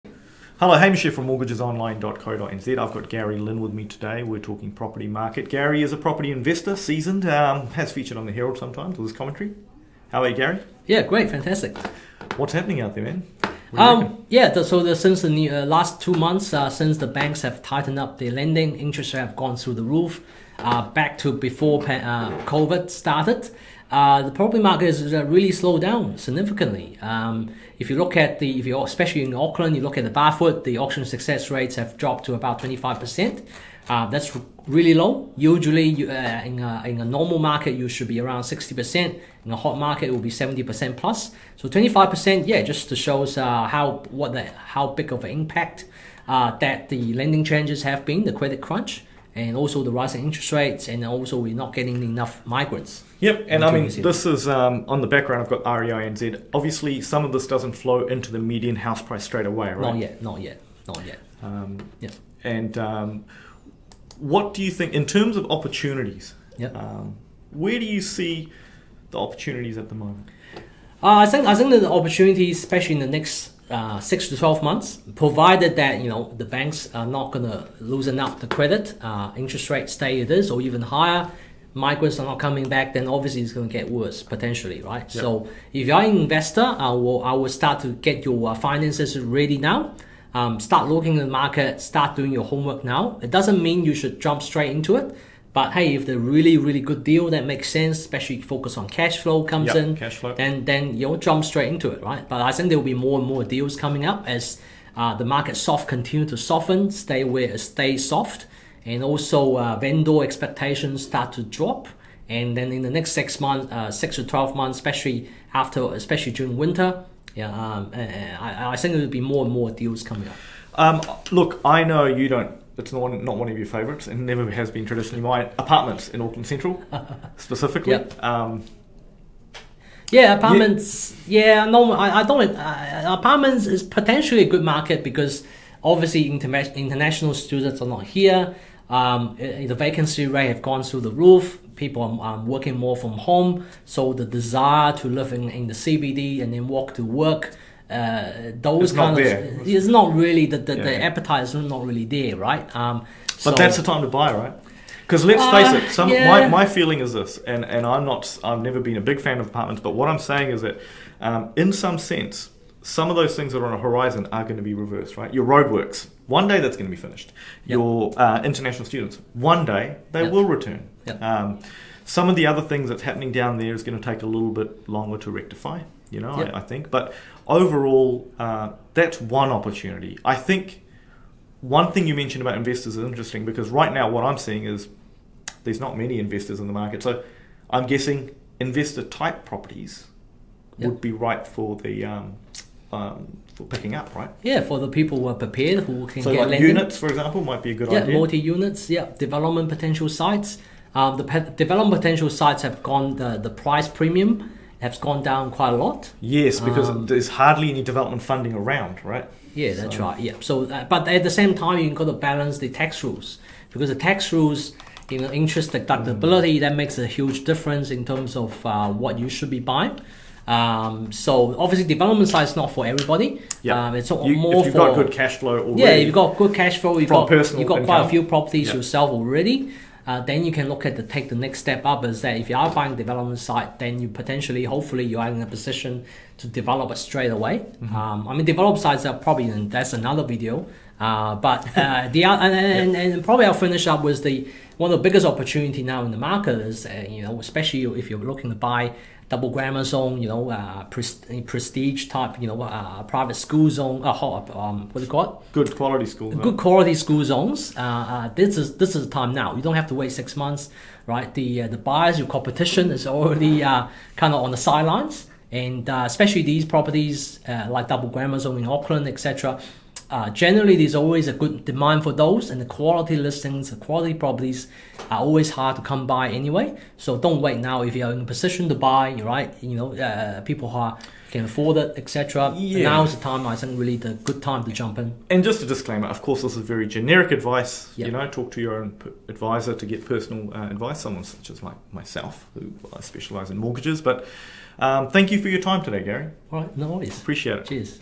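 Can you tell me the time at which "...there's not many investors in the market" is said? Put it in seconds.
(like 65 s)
185 s.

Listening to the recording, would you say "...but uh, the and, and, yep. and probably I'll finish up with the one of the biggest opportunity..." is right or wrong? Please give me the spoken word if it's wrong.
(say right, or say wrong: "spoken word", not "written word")
right.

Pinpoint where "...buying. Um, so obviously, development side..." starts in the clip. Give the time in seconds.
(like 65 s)
219 s.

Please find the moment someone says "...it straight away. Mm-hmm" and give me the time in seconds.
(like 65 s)
236 s.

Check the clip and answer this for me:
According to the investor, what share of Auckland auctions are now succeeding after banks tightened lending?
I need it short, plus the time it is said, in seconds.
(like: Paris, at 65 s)
25%, at 32 s.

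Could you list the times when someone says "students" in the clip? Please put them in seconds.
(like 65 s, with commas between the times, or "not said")
137 s, 168 s.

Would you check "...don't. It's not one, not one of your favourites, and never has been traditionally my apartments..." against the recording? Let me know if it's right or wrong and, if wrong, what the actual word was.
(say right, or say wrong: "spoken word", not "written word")
right.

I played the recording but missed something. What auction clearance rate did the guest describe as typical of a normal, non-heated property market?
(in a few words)
60%.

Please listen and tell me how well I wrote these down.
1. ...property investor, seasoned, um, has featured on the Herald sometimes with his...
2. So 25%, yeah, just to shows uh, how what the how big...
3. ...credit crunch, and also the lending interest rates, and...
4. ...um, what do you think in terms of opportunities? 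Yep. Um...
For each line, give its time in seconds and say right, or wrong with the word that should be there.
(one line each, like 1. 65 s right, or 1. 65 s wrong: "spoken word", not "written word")
1. 5 s right
2. 41 s right
3. 48 s wrong: "rising", not "lending"
4. 62 s right.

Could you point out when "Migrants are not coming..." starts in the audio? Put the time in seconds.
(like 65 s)
81 s.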